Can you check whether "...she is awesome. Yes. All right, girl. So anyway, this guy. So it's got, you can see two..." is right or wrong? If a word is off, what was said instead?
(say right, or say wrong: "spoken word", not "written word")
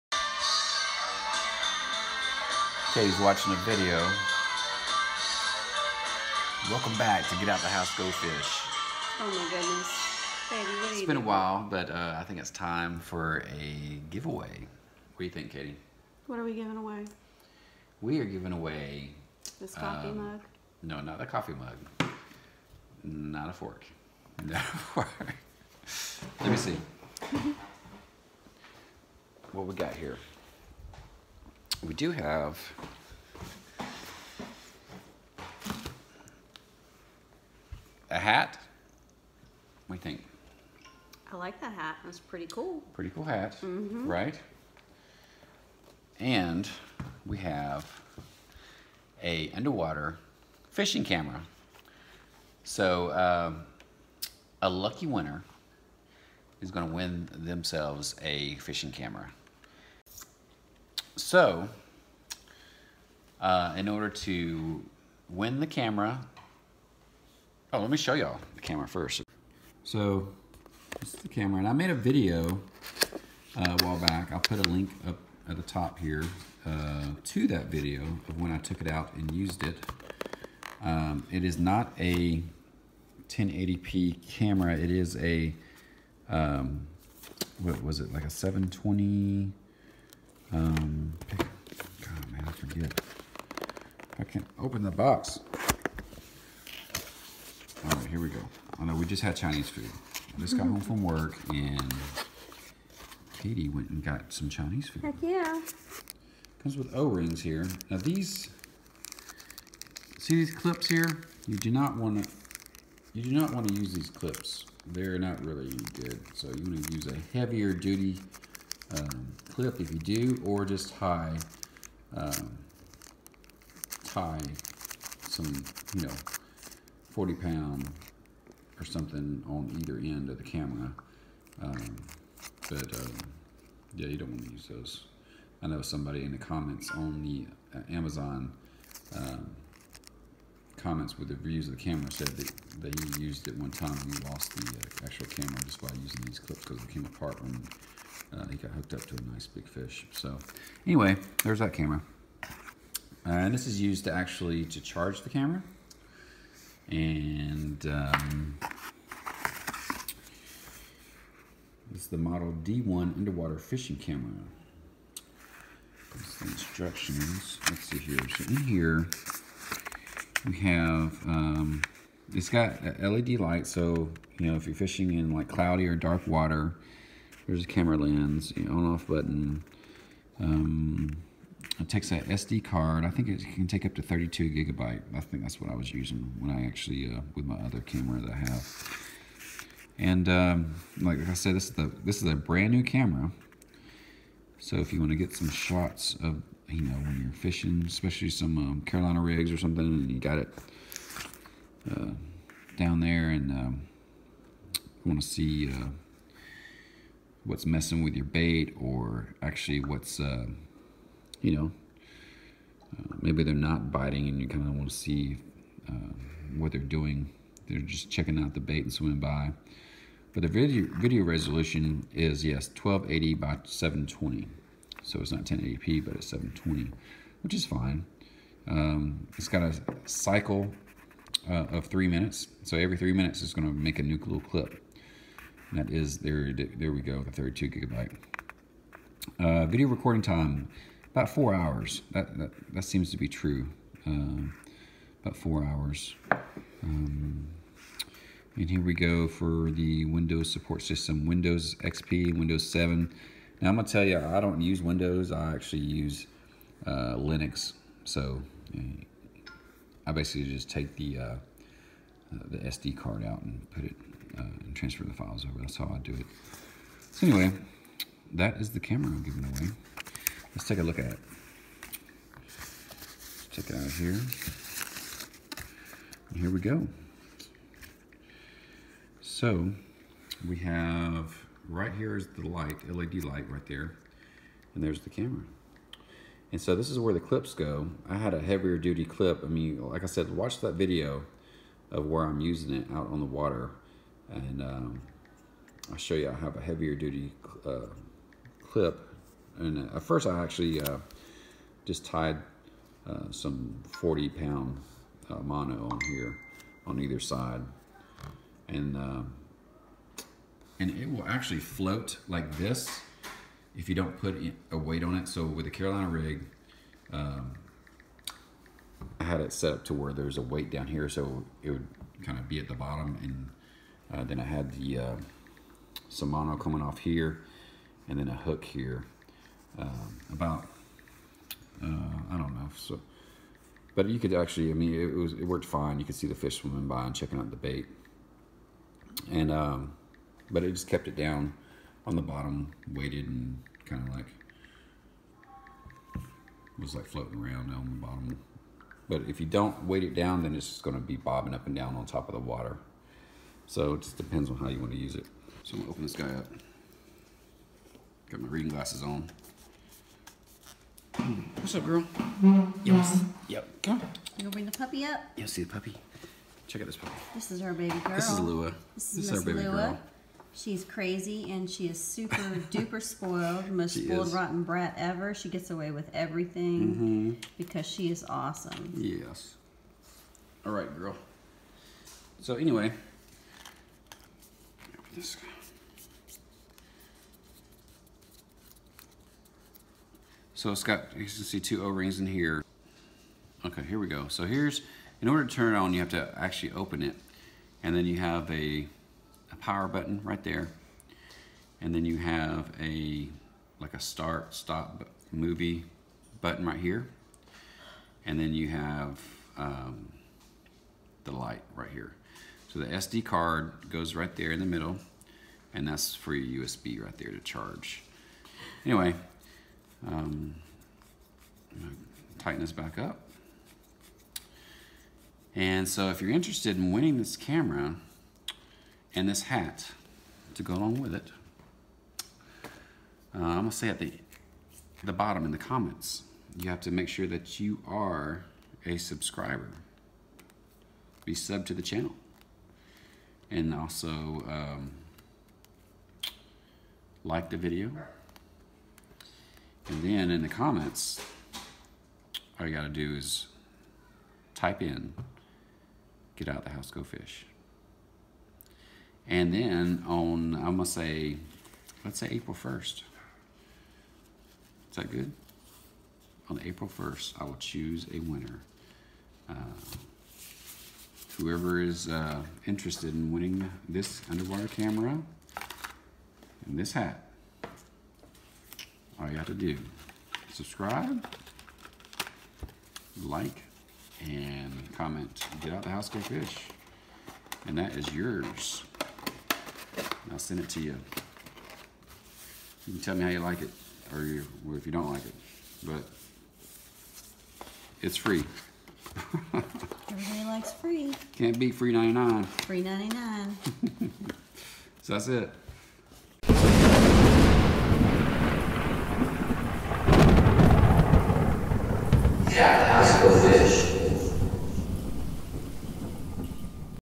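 right.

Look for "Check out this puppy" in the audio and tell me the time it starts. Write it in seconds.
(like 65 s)
366 s.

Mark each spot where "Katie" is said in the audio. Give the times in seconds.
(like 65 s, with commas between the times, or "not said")
15 s, 103 s.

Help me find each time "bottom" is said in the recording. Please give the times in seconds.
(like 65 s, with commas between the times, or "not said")
322 s, 342 s, 348 s, 435 s.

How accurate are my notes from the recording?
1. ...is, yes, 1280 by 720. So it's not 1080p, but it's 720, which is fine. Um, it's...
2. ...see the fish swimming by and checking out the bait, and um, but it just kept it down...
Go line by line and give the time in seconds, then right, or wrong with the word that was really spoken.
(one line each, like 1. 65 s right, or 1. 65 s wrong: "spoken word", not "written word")
1. 222 s right
2. 336 s right.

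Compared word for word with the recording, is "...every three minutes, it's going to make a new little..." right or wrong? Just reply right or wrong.
right.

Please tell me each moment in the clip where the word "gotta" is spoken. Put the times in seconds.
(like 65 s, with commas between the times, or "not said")
452 s.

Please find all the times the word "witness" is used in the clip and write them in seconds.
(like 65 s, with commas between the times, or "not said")
not said.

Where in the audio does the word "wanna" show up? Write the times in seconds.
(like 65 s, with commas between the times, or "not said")
354 s.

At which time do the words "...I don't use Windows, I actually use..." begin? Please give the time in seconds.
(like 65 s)
254 s.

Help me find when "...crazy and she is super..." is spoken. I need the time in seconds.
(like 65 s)
370 s.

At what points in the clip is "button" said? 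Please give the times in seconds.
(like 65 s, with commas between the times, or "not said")
179 s, 399 s, 406 s.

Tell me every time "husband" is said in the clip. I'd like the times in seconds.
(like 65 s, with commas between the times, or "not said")
not said.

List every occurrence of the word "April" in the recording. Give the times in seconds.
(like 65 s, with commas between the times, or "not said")
462 s, 466 s.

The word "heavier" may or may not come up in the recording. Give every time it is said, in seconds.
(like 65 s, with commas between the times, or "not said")
117 s, 288 s, 296 s.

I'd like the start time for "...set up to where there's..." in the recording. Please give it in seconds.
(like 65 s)
319 s.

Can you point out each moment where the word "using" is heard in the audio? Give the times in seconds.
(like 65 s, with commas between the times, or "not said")
146 s, 185 s, 292 s.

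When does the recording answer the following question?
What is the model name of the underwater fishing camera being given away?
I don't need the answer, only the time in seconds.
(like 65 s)
162 s.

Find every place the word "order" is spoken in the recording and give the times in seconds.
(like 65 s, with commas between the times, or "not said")
63 s, 395 s.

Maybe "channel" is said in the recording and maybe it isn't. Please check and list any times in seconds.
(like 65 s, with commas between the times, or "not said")
441 s.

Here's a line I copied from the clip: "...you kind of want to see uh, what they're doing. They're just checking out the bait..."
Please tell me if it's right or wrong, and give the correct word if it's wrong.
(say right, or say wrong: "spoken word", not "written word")
right.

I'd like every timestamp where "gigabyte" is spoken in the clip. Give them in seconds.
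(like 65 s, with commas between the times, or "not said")
184 s, 237 s.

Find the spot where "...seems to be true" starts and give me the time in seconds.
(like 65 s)
242 s.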